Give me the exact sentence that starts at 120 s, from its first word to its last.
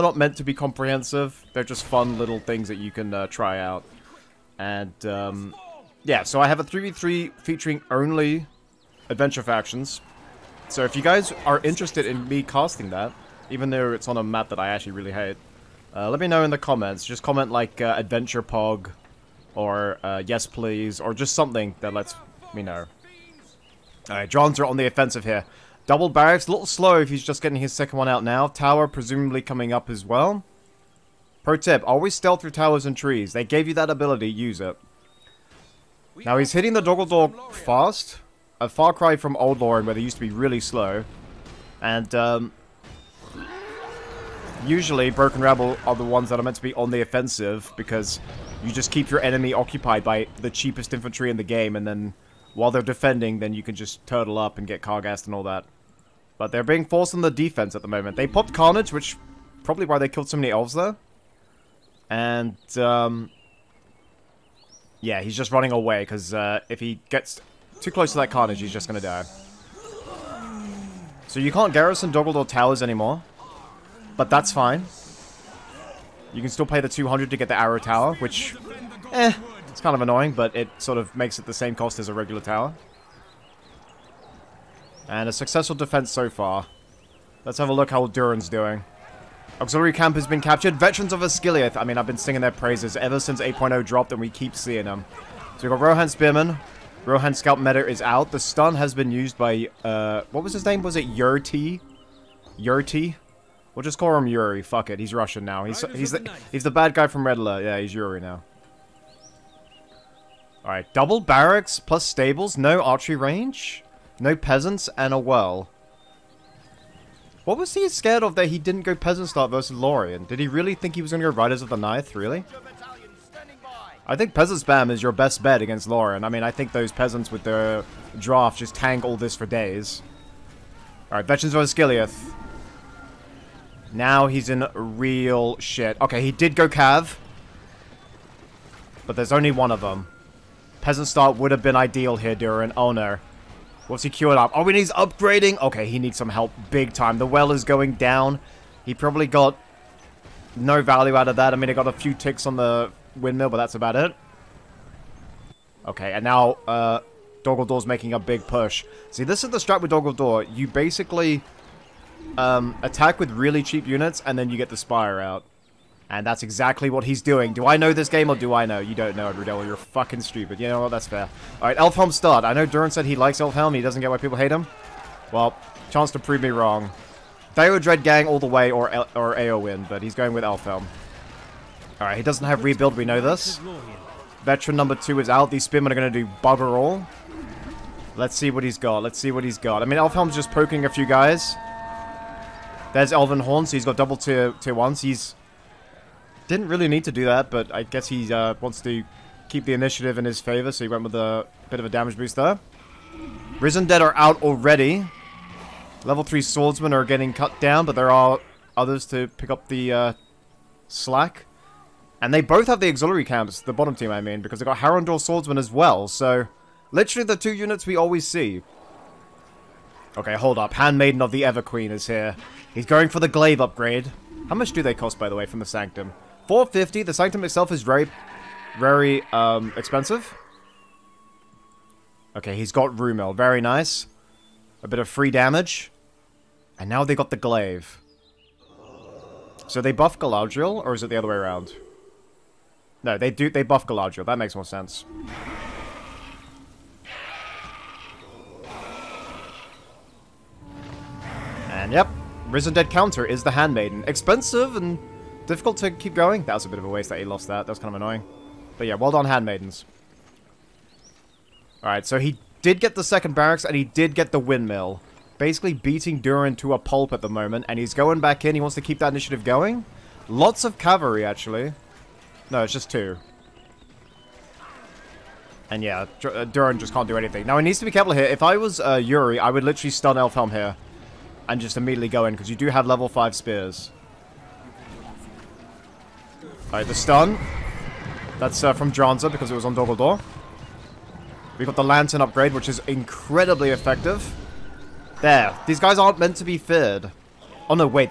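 Did he really think he was going to go Riders of the Ninth, really?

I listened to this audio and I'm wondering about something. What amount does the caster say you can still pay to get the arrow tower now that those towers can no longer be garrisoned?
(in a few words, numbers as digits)
200.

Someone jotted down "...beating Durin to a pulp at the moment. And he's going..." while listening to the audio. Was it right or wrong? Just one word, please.
right.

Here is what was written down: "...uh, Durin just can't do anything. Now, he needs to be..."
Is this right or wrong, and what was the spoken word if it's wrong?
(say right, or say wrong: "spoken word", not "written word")
right.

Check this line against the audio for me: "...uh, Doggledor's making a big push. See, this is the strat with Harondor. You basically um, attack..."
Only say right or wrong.
wrong.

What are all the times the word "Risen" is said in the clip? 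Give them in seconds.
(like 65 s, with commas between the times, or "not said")
203 s, 252 s.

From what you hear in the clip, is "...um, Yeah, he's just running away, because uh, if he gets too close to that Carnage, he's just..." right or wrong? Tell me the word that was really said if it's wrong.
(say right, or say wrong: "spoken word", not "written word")
right.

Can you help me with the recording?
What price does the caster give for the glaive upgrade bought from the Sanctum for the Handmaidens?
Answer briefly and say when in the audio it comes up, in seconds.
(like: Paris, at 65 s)
450, at 226 s.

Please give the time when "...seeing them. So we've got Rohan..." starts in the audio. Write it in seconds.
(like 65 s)
94 s.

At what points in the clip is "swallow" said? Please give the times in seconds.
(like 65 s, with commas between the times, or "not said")
not said.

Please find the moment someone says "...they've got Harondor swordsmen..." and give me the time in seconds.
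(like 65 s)
214 s.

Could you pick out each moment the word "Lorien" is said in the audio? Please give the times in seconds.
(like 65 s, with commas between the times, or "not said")
39 s, 119 s, 125 s.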